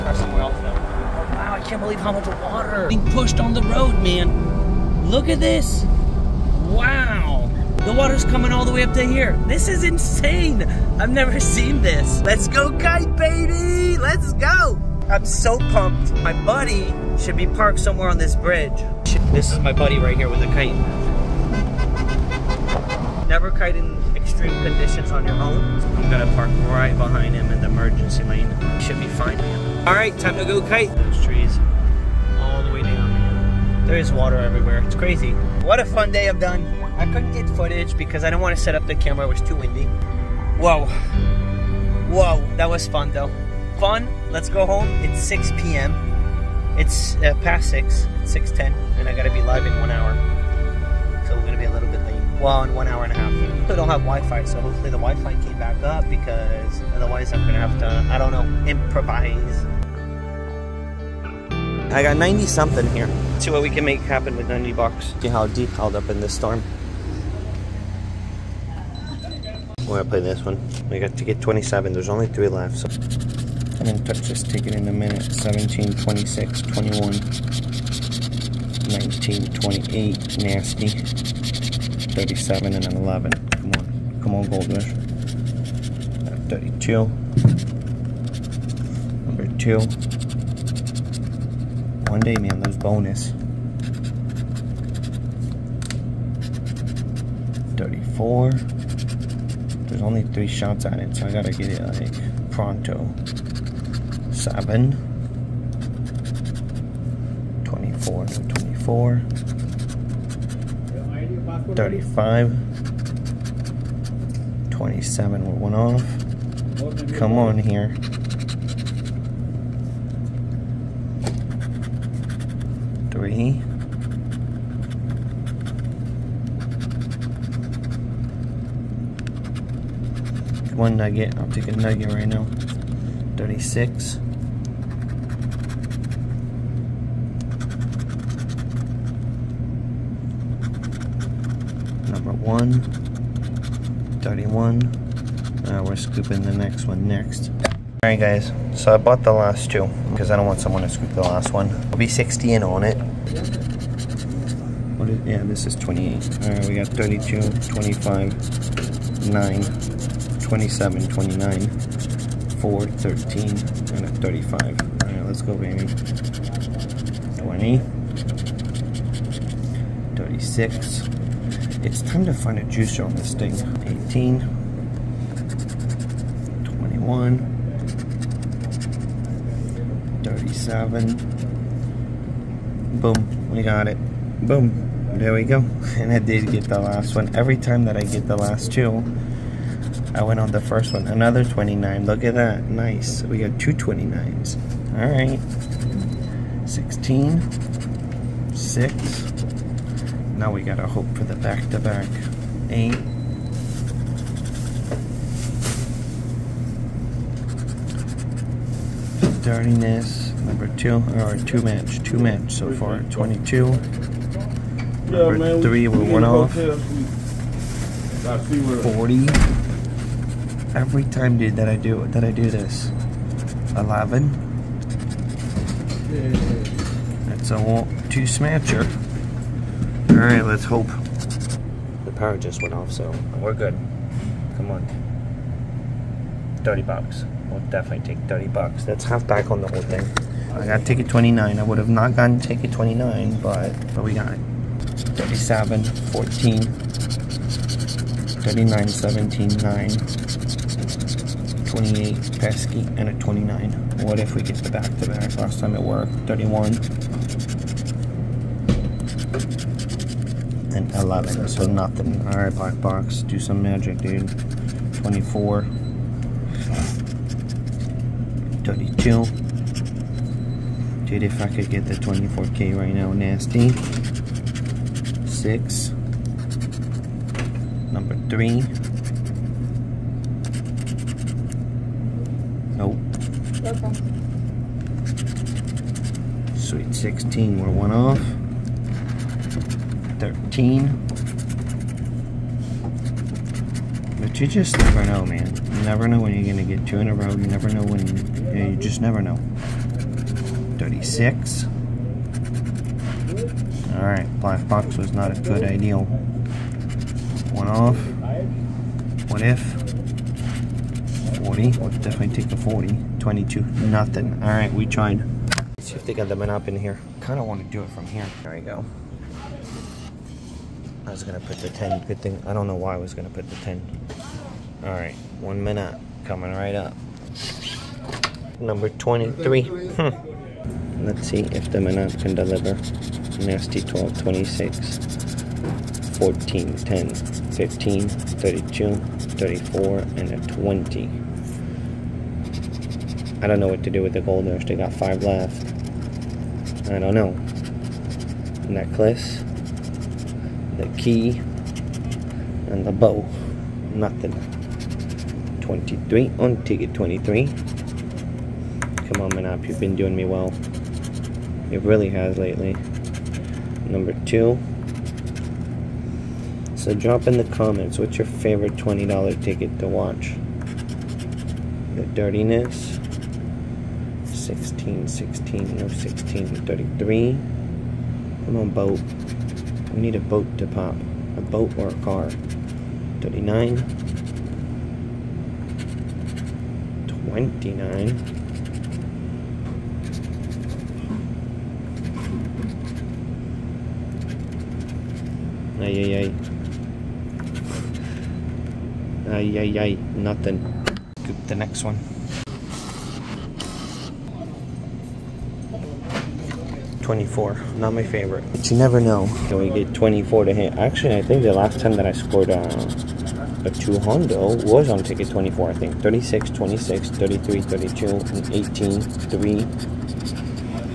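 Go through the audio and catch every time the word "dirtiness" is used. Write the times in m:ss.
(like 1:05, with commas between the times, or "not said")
3:29, 6:12.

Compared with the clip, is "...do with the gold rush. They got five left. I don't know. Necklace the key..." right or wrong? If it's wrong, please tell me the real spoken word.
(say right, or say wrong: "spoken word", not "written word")
right.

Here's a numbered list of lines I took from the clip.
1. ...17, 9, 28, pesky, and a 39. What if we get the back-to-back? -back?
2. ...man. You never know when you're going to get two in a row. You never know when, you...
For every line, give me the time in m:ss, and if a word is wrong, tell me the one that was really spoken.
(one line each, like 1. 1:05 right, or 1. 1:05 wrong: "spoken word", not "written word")
1. 4:08 wrong: "29", not "39"
2. 4:55 right.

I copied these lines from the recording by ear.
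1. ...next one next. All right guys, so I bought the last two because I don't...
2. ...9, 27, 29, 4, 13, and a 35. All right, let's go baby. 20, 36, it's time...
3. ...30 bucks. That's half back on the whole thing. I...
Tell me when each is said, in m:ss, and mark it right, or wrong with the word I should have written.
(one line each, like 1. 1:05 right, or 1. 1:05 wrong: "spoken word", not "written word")
1. 2:26 right
2. 2:39 right
3. 3:58 right.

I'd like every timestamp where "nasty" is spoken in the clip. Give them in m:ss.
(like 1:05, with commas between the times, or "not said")
1:20, 4:33, 5:33.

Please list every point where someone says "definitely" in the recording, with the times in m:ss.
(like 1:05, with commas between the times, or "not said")
3:57, 5:12.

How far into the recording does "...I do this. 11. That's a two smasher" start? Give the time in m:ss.
3:42.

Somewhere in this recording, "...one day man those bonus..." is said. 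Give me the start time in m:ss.
1:32.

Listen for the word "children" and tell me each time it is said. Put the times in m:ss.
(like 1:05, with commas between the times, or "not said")
not said.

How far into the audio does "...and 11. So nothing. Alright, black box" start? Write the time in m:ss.
4:20.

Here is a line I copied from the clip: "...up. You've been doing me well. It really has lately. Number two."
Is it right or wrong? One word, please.
right.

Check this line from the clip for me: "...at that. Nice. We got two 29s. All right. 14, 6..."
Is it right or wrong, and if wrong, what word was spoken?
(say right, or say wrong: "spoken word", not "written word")
wrong: "16", not "14".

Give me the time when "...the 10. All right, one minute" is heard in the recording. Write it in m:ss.
5:23.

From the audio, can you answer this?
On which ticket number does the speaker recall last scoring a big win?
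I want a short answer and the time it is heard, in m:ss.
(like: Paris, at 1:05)
24, at 6:55.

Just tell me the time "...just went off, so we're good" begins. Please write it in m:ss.
3:52.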